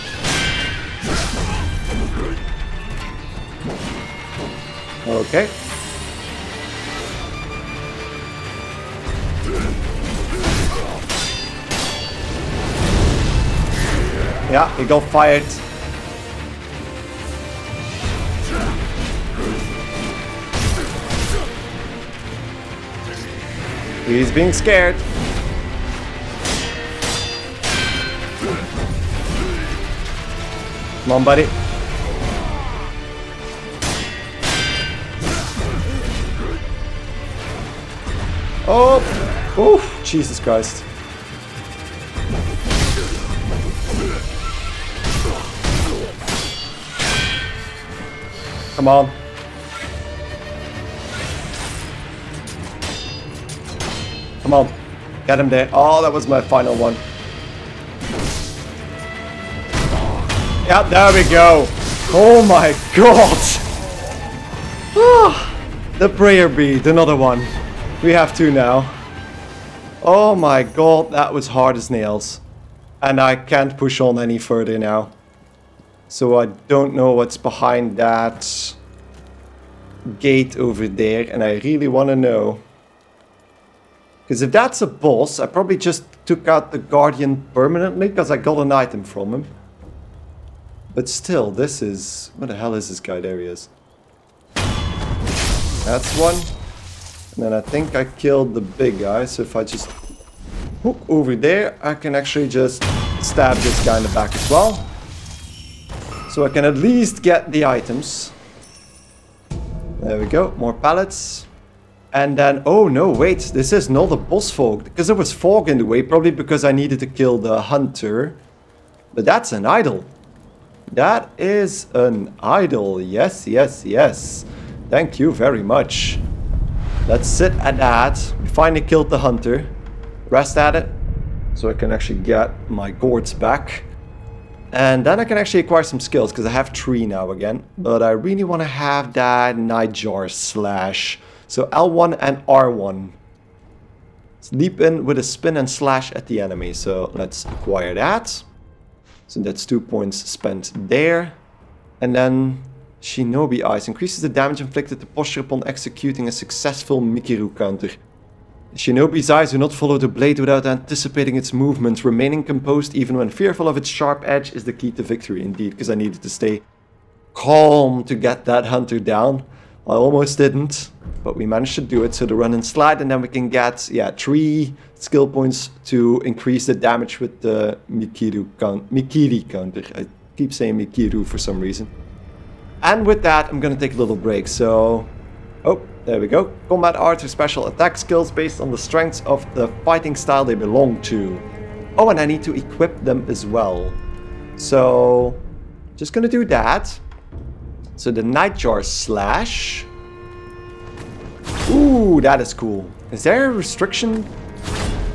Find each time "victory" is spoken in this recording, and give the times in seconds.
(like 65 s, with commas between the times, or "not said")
165 s.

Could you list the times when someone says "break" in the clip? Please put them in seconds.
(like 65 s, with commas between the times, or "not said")
184 s.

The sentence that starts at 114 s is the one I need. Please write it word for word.
Because there was fog in the way, probably because I needed to kill the hunter.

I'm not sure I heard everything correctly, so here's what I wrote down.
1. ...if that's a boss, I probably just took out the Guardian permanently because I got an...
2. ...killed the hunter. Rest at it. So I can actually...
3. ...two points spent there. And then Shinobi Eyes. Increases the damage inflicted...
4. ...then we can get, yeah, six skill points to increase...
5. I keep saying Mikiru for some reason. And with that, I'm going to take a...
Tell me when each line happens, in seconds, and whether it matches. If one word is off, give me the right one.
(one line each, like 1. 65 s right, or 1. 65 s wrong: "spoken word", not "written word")
1. 84 s right
2. 128 s right
3. 149 s right
4. 173 s wrong: "three", not "six"
5. 179 s right.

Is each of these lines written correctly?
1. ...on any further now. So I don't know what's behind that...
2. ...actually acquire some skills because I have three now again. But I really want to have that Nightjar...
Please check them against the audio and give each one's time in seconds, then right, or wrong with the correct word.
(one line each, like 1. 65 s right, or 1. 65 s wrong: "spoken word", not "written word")
1. 73 s right
2. 135 s right.